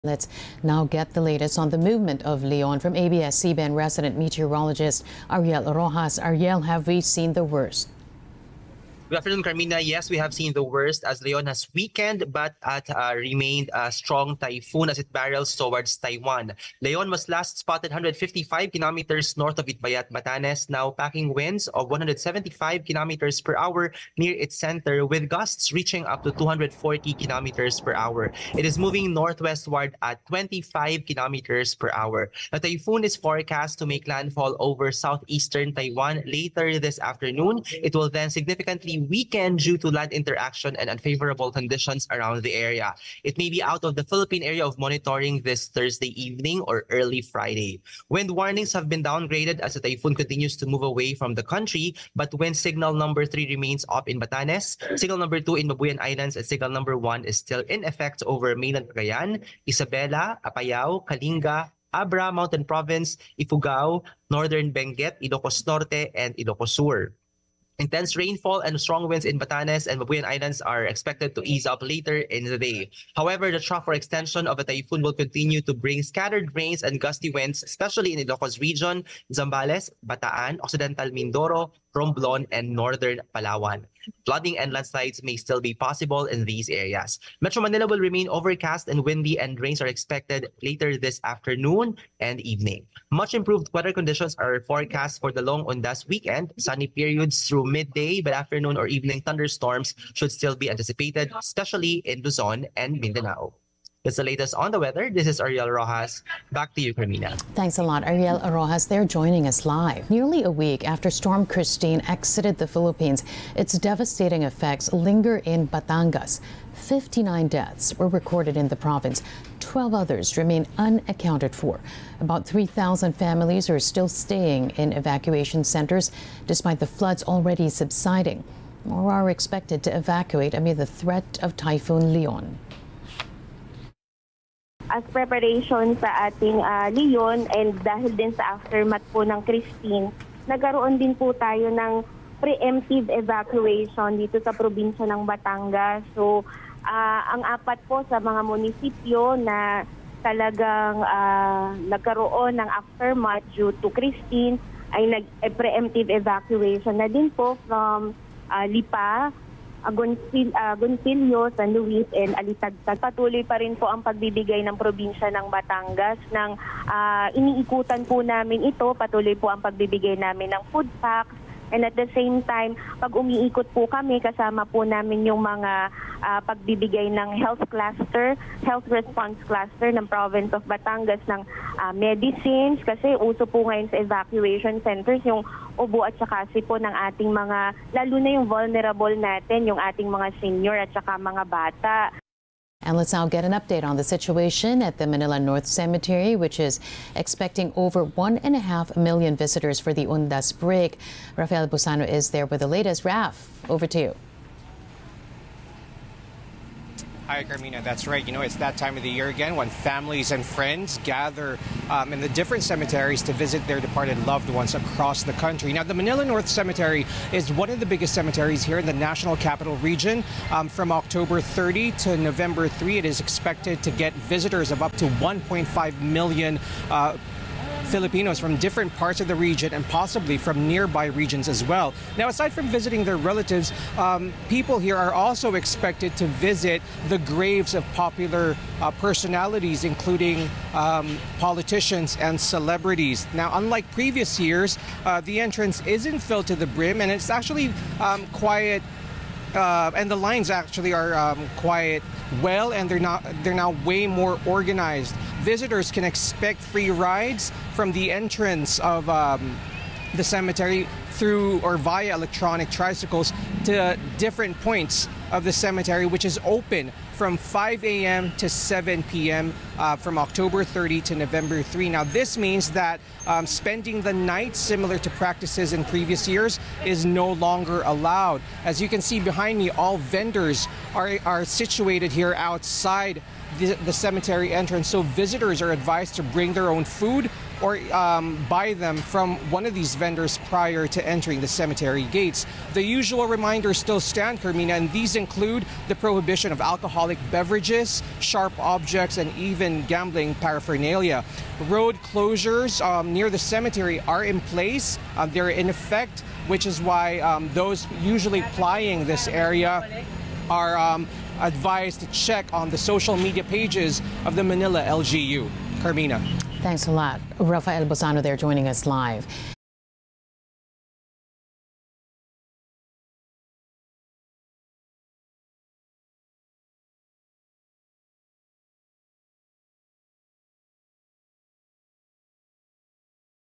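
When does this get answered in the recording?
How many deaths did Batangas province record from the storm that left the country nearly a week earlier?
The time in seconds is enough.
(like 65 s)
116 s.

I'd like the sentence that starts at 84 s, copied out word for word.
Flooding and landslides may still be possible in these areas.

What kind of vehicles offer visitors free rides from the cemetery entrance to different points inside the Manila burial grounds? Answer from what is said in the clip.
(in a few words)
electronic tricycles.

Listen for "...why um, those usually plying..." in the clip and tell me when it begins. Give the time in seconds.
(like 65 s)
306 s.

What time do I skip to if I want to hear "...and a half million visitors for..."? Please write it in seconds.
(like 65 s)
198 s.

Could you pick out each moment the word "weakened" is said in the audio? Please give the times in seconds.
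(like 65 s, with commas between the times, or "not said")
11 s, 39 s.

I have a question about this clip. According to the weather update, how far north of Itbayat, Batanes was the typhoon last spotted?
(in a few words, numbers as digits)
155 kilometers.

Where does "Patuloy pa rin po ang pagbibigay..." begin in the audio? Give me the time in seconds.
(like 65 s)
163 s.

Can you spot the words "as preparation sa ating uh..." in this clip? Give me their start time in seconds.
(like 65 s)
134 s.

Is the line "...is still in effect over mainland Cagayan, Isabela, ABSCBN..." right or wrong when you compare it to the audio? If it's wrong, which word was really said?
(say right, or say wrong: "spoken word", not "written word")
wrong: "Apayao", not "ABSCBN".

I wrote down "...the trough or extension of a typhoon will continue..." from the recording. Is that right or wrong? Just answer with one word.
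right.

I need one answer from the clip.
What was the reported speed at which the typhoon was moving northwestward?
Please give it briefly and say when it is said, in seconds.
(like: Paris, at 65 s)
25 kilometers per hour, at 30 s.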